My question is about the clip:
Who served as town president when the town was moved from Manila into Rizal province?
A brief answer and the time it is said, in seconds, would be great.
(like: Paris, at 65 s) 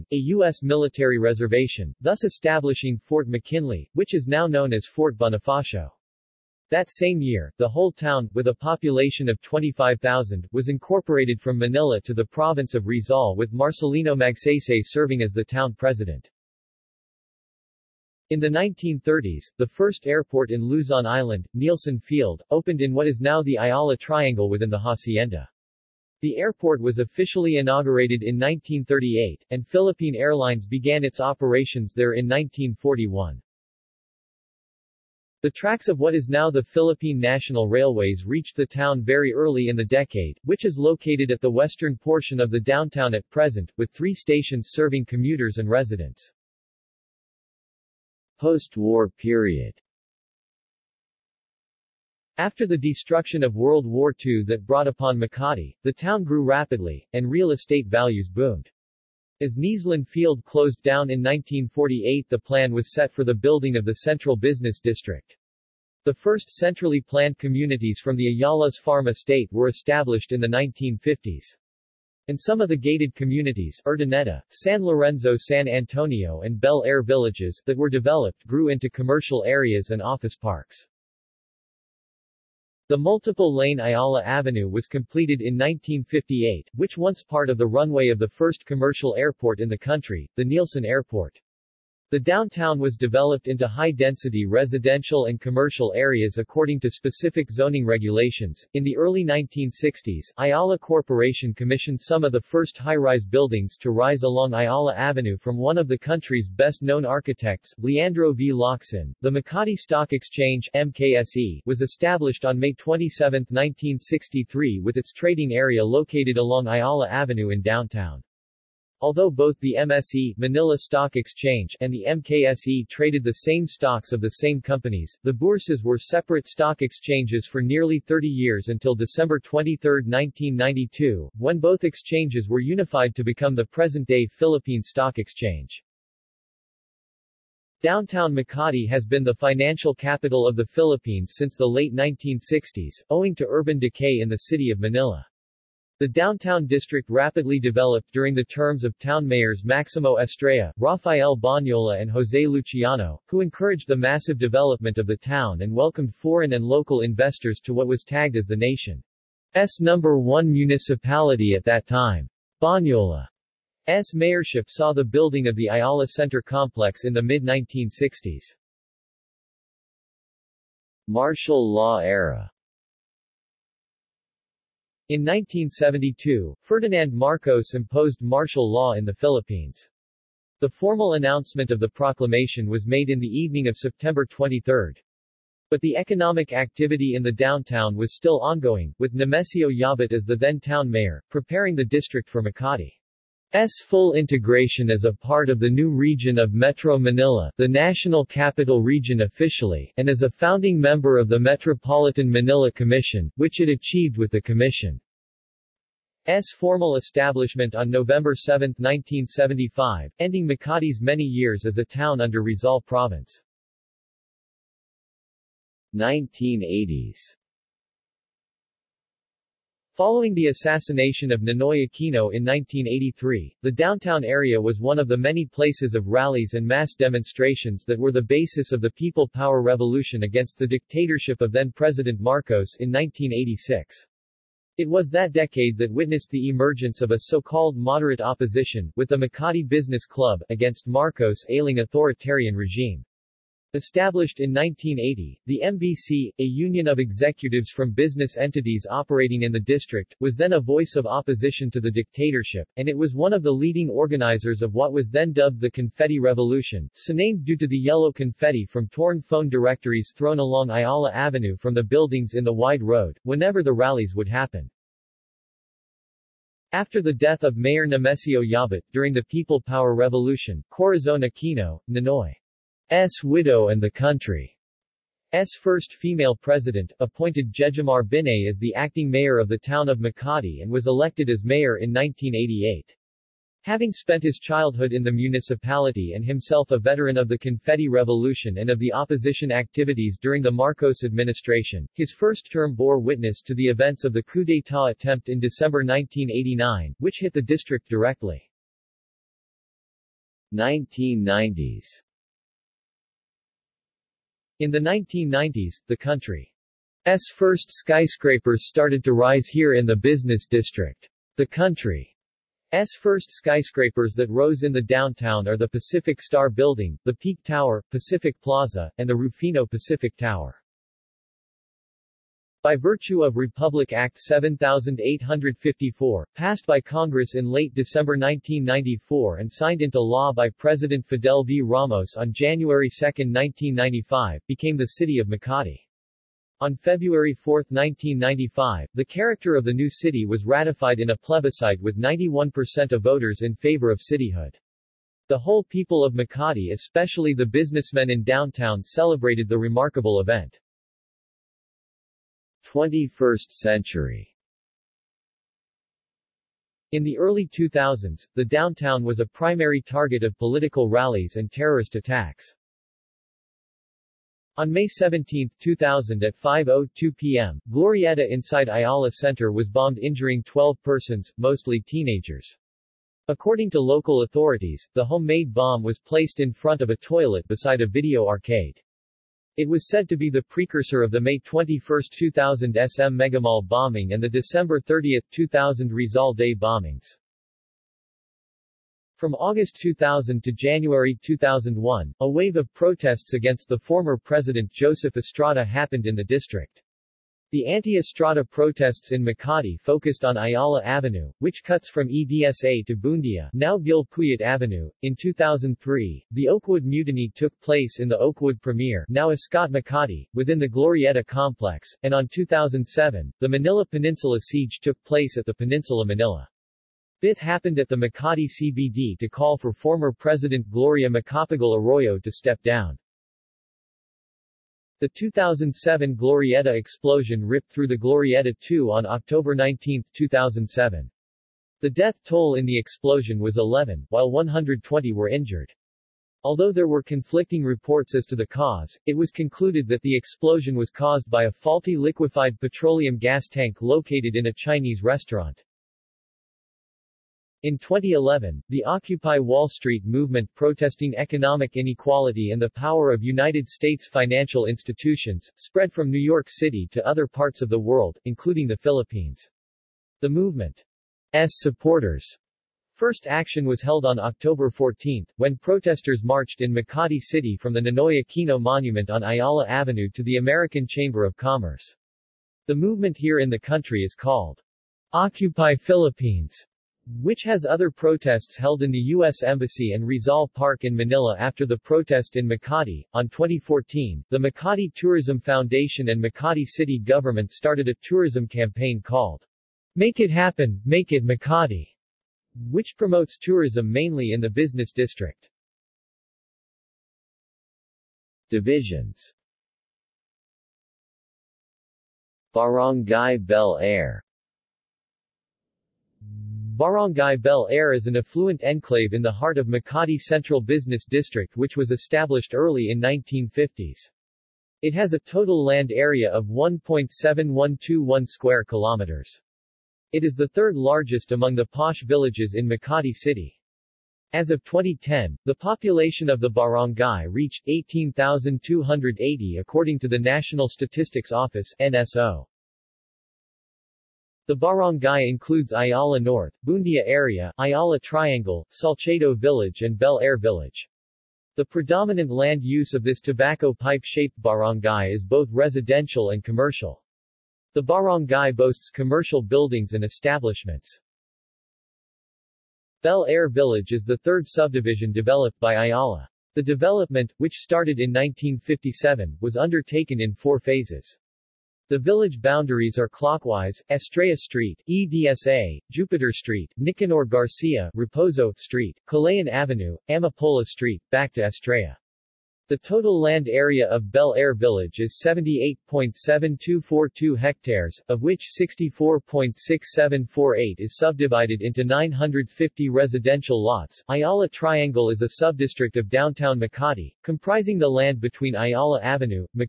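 Marcelino Magsaysay, at 13 s.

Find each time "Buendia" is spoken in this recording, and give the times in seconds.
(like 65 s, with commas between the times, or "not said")
402 s, 536 s.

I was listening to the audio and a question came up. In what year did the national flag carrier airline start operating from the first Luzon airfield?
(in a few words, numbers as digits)
1941.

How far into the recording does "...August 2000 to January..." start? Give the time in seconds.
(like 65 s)
389 s.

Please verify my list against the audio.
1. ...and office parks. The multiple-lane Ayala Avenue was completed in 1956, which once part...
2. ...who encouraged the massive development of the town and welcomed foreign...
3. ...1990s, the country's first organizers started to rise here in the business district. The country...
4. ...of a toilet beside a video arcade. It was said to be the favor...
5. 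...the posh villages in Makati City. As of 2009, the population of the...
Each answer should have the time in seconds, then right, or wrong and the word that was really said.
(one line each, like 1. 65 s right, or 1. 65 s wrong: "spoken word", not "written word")
1. 79 s wrong: "1958", not "1956"
2. 153 s right
3. 304 s wrong: "skyscrapers", not "organizers"
4. 376 s wrong: "precursor", not "favor"
5. 521 s wrong: "2010", not "2009".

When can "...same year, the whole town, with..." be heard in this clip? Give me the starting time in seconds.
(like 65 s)
6 s.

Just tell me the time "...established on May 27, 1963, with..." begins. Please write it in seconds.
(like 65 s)
111 s.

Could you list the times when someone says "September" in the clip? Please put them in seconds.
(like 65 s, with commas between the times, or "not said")
183 s.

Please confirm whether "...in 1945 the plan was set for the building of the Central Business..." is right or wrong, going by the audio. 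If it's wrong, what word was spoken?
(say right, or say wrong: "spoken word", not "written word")
wrong: "1948", not "1945".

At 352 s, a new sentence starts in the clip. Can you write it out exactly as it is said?
21st century In the early 2000s, the downtown was a primary target of political rallies and terrorist attacks.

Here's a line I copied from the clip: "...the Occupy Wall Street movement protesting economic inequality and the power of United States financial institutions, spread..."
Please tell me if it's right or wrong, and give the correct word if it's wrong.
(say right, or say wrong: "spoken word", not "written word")
right.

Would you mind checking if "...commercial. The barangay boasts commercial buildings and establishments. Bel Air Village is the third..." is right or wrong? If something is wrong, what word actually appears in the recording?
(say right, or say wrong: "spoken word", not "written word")
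right.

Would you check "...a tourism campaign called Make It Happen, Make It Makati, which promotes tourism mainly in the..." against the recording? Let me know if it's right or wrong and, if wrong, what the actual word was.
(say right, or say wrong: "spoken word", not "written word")
right.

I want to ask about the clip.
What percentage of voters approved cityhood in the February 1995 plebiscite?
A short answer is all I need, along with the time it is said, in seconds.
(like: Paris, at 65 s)
91%, at 341 s.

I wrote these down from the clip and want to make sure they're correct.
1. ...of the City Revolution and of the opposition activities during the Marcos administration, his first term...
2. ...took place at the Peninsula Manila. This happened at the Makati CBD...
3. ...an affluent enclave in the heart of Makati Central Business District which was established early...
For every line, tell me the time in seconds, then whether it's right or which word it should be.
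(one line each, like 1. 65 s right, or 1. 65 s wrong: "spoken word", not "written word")
1. 287 s wrong: "Confetti", not "City"
2. 414 s right
3. 508 s right.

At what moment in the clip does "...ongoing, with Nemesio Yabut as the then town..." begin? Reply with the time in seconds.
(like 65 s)
188 s.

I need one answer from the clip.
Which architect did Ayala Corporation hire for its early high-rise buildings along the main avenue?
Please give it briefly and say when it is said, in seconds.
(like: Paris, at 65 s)
Leandro V. Locsin, at 107 s.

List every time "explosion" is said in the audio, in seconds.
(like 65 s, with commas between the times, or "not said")
426 s, 432 s, 440 s.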